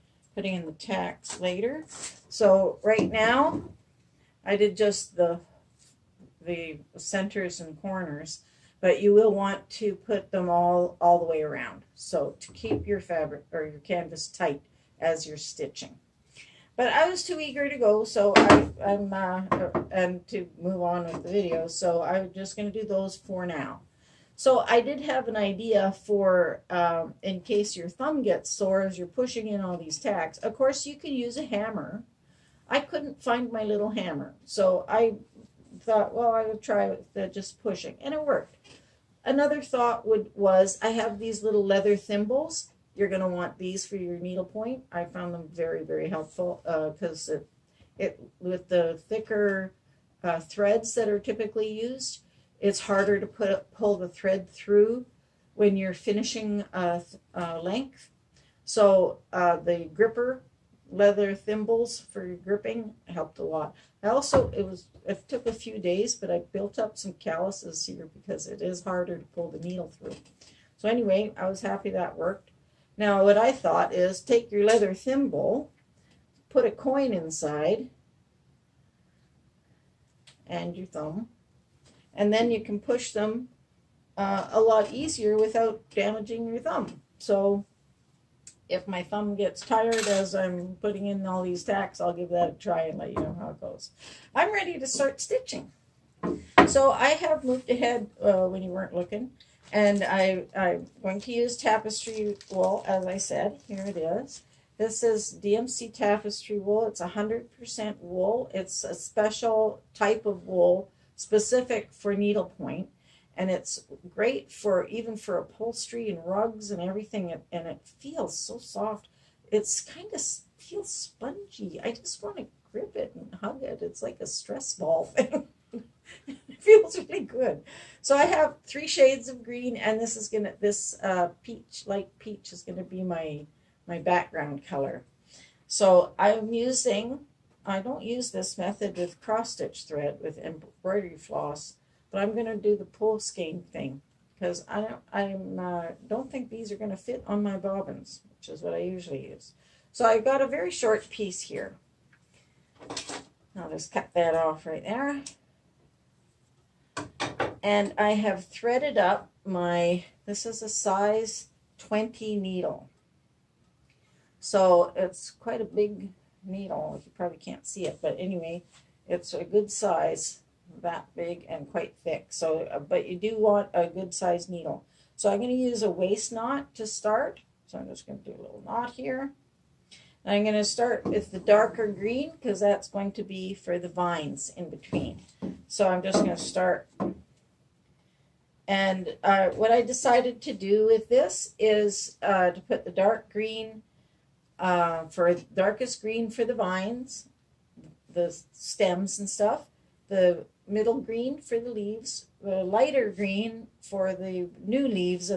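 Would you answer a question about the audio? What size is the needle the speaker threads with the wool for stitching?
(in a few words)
20.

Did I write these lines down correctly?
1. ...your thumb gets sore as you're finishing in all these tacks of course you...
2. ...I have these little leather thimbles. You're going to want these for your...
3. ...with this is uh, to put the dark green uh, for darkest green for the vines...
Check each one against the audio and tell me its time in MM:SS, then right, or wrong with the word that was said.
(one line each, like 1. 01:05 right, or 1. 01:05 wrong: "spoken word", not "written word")
1. 00:27 wrong: "pushing", not "finishing"
2. 00:40 right
3. 03:10 right.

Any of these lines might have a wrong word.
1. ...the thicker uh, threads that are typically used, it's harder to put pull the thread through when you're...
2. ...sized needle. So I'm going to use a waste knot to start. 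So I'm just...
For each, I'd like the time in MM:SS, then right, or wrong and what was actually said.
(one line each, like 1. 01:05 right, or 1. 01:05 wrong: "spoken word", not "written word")
1. 00:48 right
2. 02:54 right.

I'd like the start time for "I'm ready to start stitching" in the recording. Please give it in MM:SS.
01:34.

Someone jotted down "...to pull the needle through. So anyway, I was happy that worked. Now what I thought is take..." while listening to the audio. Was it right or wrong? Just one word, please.
right.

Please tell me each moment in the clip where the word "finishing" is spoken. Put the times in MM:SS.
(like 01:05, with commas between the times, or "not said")
00:55.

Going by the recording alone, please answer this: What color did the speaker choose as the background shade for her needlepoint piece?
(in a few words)
Light peach.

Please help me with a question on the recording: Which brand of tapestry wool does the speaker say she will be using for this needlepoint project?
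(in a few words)
DMC.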